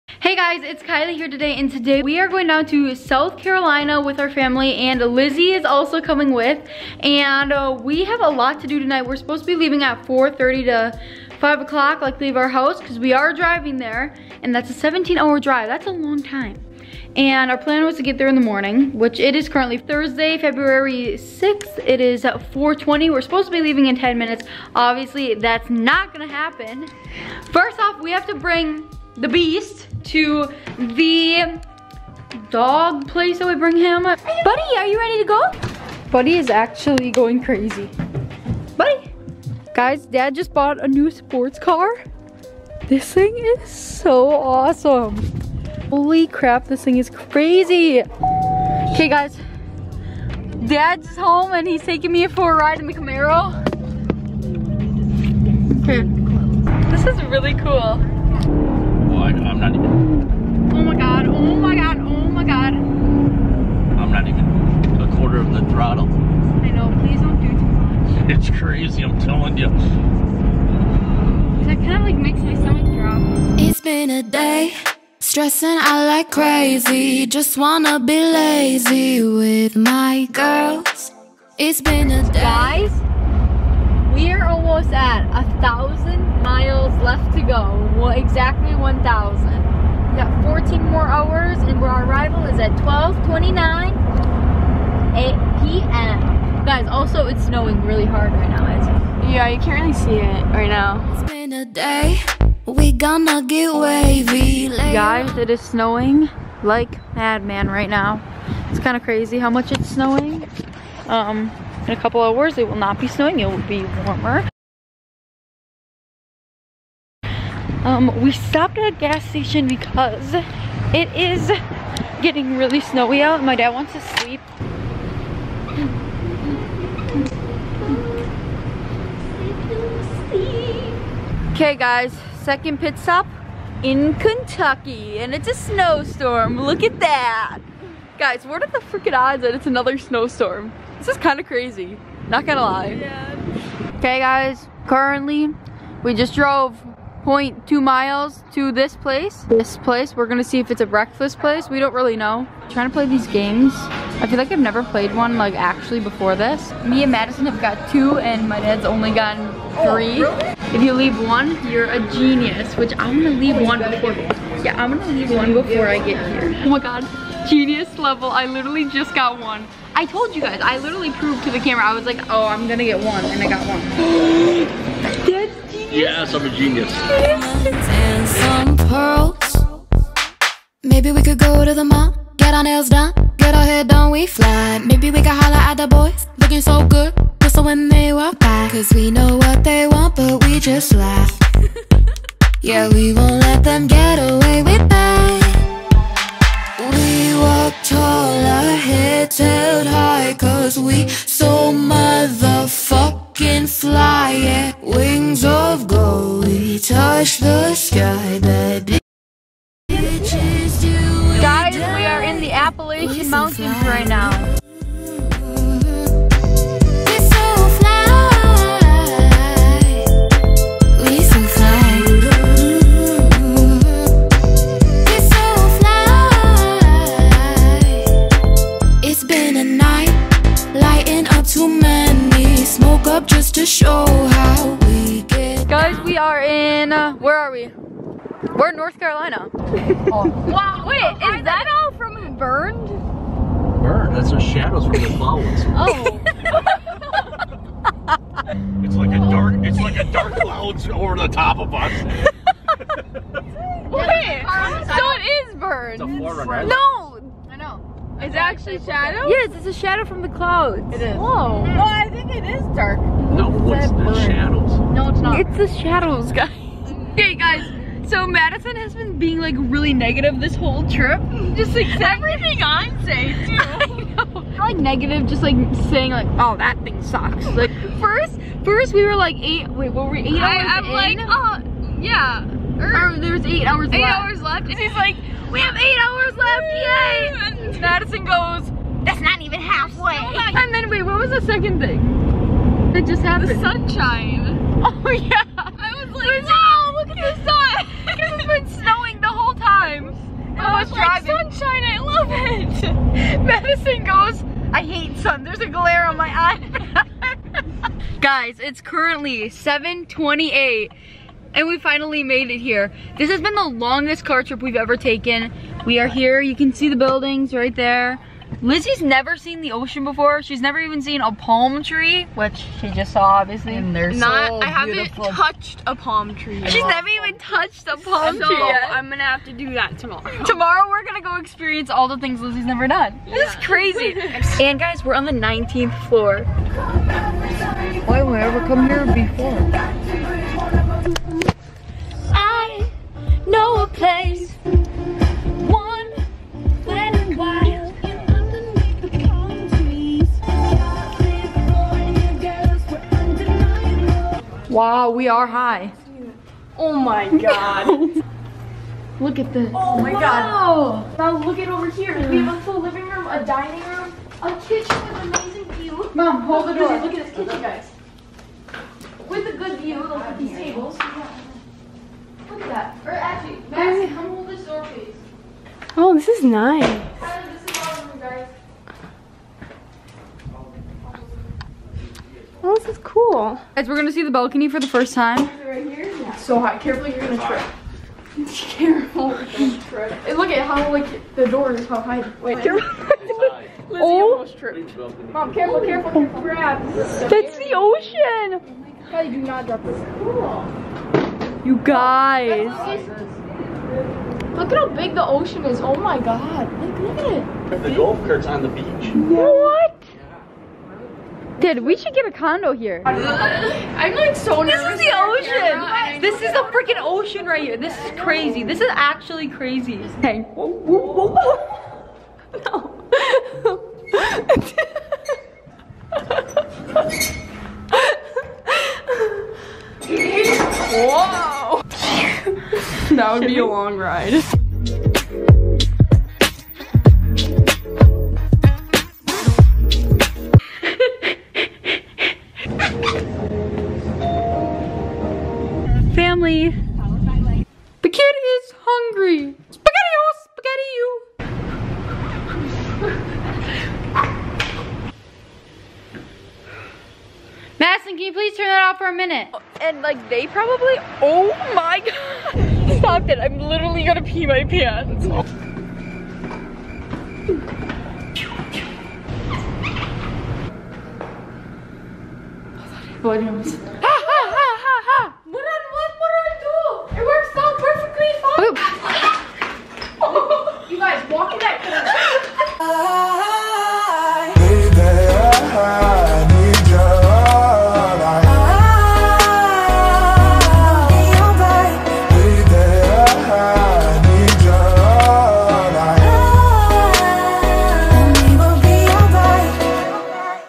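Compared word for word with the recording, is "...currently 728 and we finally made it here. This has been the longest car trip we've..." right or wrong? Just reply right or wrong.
right.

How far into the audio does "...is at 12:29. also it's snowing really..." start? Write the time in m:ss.
1:32.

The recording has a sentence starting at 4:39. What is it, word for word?
Wait, what were we eight I, hours I'm in?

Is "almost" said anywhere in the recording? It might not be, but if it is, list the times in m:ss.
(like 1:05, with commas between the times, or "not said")
1:24, 6:34.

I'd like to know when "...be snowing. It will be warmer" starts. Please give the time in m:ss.
1:52.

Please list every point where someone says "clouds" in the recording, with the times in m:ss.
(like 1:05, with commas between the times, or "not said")
4:05, 4:10, 4:20.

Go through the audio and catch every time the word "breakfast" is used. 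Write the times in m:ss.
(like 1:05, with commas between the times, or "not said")
2:30.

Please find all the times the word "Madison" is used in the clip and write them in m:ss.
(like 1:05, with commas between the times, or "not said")
2:37, 4:28, 4:47.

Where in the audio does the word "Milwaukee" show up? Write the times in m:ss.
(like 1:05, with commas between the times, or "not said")
not said.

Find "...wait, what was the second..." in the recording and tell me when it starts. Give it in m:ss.
4:50.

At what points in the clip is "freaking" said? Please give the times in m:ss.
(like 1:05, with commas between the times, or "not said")
2:18, 6:56.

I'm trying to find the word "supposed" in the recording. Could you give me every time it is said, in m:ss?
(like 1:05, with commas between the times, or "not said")
0:09, 0:23.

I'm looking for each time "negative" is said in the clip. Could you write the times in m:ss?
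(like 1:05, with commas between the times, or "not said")
4:29, 4:34.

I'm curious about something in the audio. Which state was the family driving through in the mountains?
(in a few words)
North Carolina.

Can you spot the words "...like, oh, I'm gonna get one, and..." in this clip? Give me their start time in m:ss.
2:52.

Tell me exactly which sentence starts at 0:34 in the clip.
Buddy, are you ready to go?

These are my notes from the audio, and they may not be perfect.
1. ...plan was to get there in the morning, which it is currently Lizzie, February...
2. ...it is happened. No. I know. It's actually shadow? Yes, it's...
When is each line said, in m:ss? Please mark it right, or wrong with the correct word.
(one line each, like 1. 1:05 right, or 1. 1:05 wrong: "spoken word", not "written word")
1. 0:17 wrong: "Thursday", not "Lizzie"
2. 4:15 wrong: "burned", not "happened".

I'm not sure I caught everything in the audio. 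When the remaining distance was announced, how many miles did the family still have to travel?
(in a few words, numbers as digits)
1,000.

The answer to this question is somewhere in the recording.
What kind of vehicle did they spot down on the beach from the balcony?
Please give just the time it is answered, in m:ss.
6:47.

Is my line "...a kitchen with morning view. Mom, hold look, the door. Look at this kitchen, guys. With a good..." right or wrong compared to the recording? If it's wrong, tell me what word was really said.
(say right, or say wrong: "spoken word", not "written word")
wrong: "amazing", not "morning".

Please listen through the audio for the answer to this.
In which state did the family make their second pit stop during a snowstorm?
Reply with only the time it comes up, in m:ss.
2:14.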